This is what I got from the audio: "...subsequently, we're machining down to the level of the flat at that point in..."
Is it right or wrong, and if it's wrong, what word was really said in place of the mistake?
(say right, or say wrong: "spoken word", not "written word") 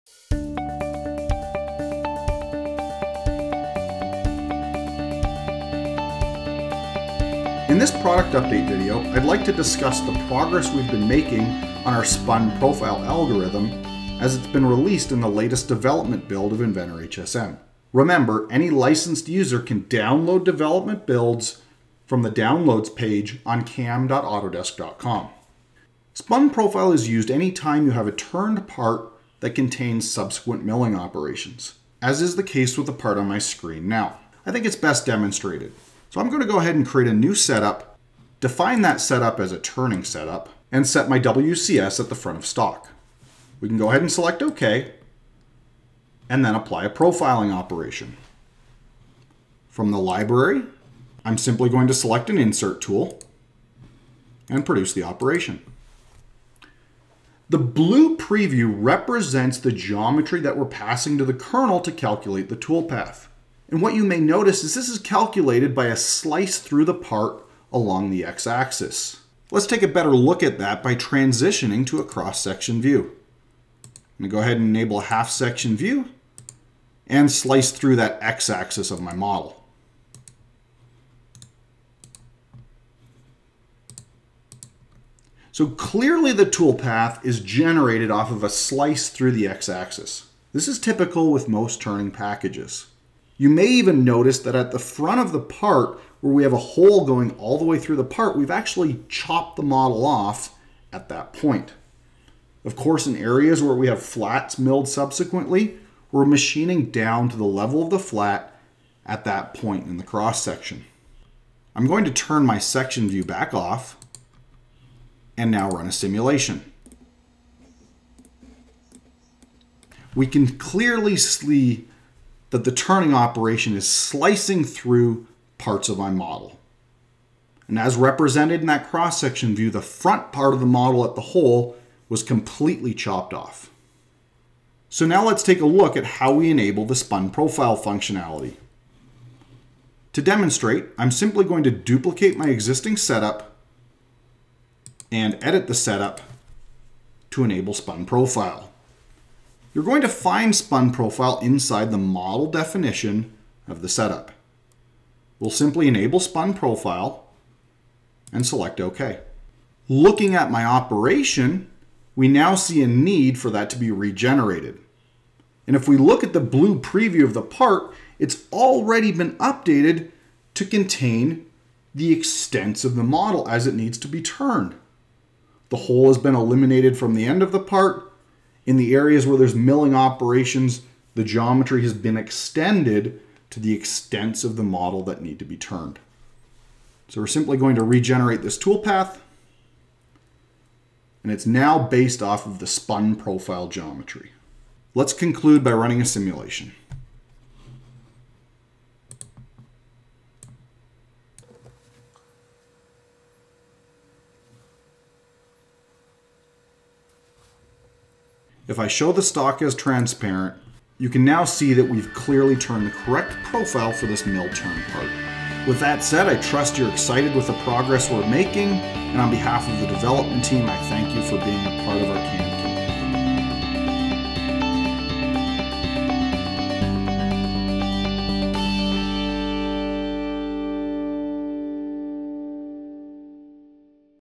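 right.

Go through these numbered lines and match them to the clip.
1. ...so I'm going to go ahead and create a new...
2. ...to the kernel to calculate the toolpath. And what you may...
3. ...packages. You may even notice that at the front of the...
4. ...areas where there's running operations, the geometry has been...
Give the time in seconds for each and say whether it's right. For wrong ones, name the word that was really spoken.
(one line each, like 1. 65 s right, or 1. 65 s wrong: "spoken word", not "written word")
1. 36 s right
2. 61 s right
3. 92 s right
4. 178 s wrong: "milling", not "running".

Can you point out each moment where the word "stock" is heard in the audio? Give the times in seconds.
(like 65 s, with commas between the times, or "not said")
42 s, 209 s.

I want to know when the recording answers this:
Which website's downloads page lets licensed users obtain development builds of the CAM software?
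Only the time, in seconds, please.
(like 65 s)
23 s.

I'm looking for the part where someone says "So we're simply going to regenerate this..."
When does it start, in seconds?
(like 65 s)
187 s.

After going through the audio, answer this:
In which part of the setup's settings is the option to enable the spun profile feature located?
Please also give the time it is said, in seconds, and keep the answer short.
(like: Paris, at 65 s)
model definition, at 151 s.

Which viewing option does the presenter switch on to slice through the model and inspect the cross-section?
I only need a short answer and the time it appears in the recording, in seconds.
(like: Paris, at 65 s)
half section view, at 75 s.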